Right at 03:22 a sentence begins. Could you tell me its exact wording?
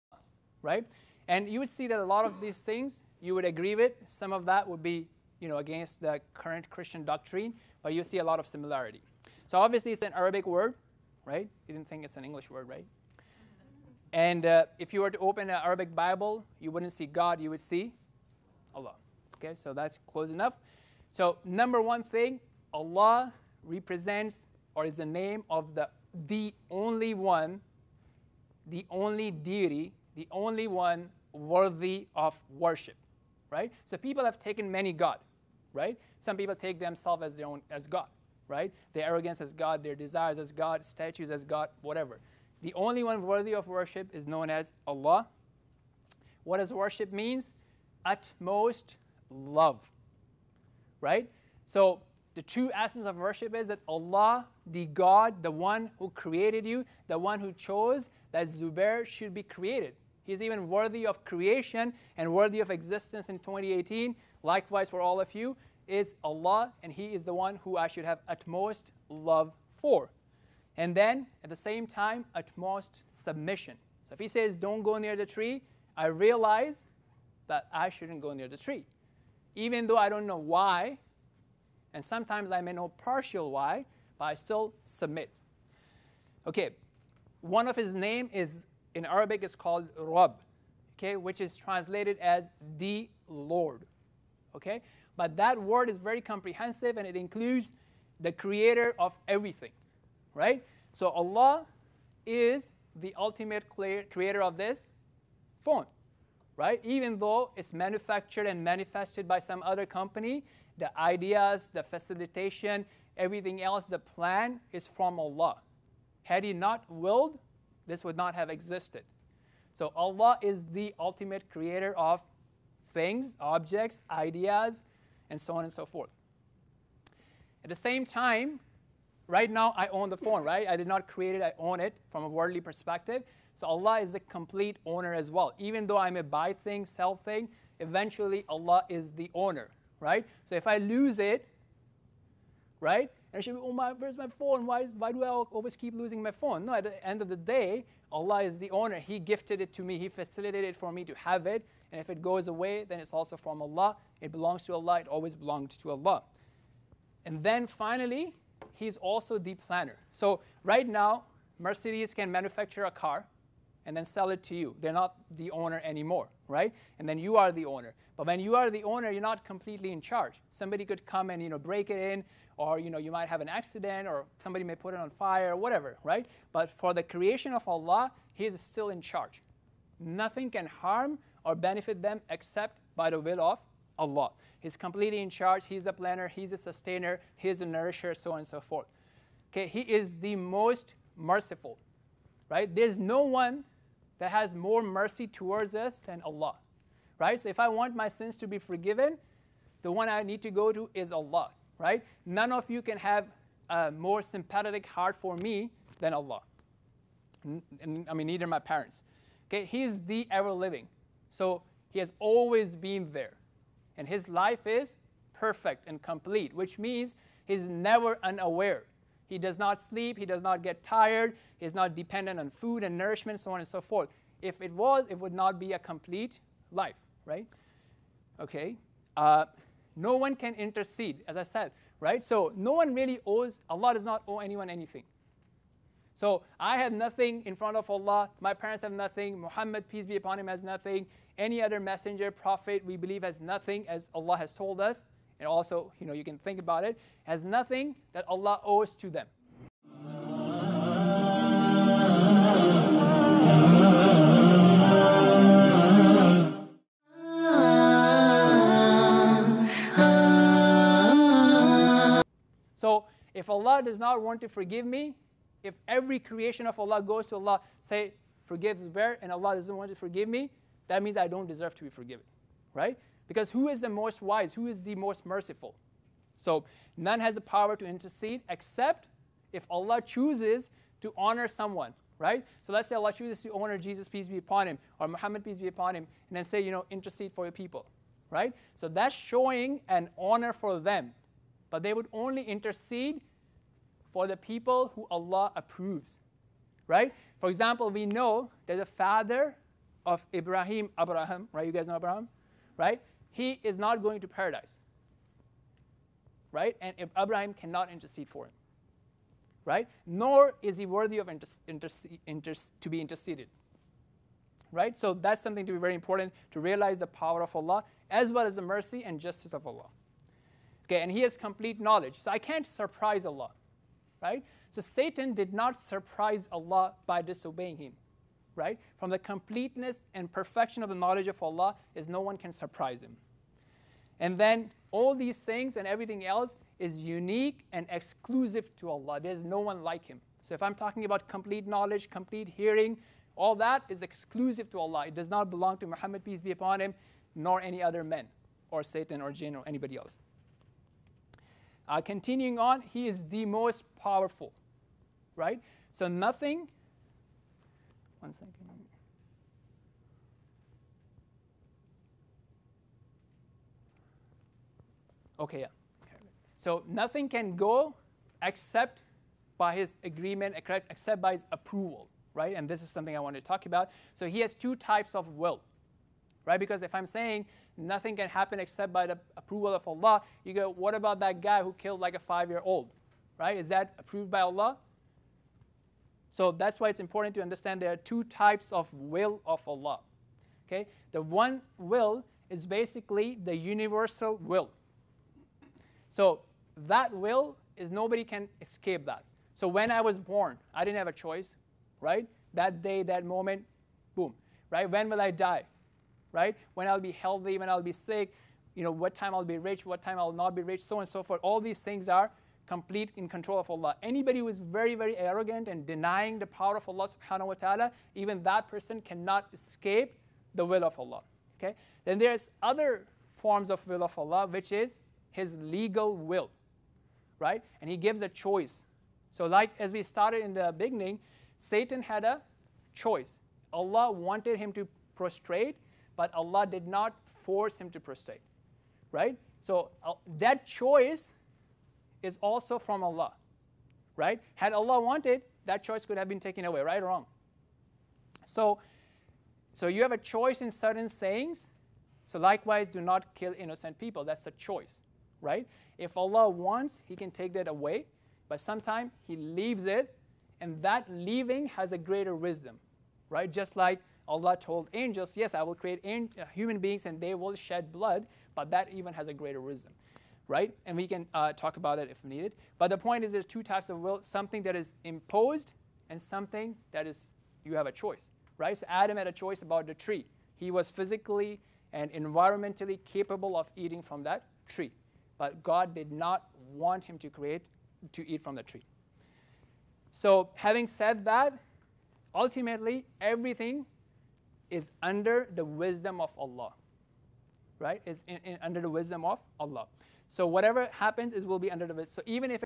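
None of you can have a more sympathetic heart for me than Allah.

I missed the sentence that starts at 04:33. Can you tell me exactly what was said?
Because who is the most wise?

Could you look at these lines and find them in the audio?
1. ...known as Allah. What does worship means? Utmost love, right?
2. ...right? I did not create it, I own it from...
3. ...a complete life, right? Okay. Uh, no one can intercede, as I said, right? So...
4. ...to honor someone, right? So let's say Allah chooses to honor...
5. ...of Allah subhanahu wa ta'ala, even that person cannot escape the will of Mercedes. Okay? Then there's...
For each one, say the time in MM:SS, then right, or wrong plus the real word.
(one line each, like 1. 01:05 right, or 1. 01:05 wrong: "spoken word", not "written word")
1. 00:44 right
2. 02:10 right
3. 03:45 right
4. 04:41 right
5. 06:56 wrong: "Allah", not "Mercedes".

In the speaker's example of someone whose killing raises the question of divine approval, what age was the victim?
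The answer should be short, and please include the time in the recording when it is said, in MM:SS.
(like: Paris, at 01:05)
5, at 06:22.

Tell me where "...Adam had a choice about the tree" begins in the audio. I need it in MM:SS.
07:58.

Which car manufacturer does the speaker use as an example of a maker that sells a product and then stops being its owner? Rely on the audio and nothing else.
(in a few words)
Mercedes.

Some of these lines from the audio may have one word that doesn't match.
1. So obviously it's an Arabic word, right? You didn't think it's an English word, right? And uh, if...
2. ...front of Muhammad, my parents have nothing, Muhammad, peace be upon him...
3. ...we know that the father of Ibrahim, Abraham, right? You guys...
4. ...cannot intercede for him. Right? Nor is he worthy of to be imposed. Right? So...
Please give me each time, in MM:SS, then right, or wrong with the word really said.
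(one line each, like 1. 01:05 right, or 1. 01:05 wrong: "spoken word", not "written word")
1. 00:09 right
2. 03:57 wrong: "Allah", not "Muhammad"
3. 04:57 right
4. 05:07 wrong: "interceded", not "imposed".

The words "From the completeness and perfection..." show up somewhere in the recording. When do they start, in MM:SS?
05:28.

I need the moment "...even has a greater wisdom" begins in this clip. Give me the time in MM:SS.
07:48.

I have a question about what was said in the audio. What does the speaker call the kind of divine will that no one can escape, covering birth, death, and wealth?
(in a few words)
universal will.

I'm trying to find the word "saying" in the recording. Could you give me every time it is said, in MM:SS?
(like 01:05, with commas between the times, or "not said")
06:17, 07:31.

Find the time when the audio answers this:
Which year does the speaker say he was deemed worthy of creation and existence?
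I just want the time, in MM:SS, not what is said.
01:03.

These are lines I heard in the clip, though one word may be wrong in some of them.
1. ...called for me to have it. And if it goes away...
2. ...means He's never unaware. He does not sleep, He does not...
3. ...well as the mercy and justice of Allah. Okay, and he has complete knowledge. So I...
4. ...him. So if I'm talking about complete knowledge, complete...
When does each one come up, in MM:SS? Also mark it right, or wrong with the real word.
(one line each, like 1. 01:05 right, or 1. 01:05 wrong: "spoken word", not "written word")
1. 02:30 wrong: "facilitated", not "called"
2. 03:36 right
3. 05:18 right
4. 05:40 right.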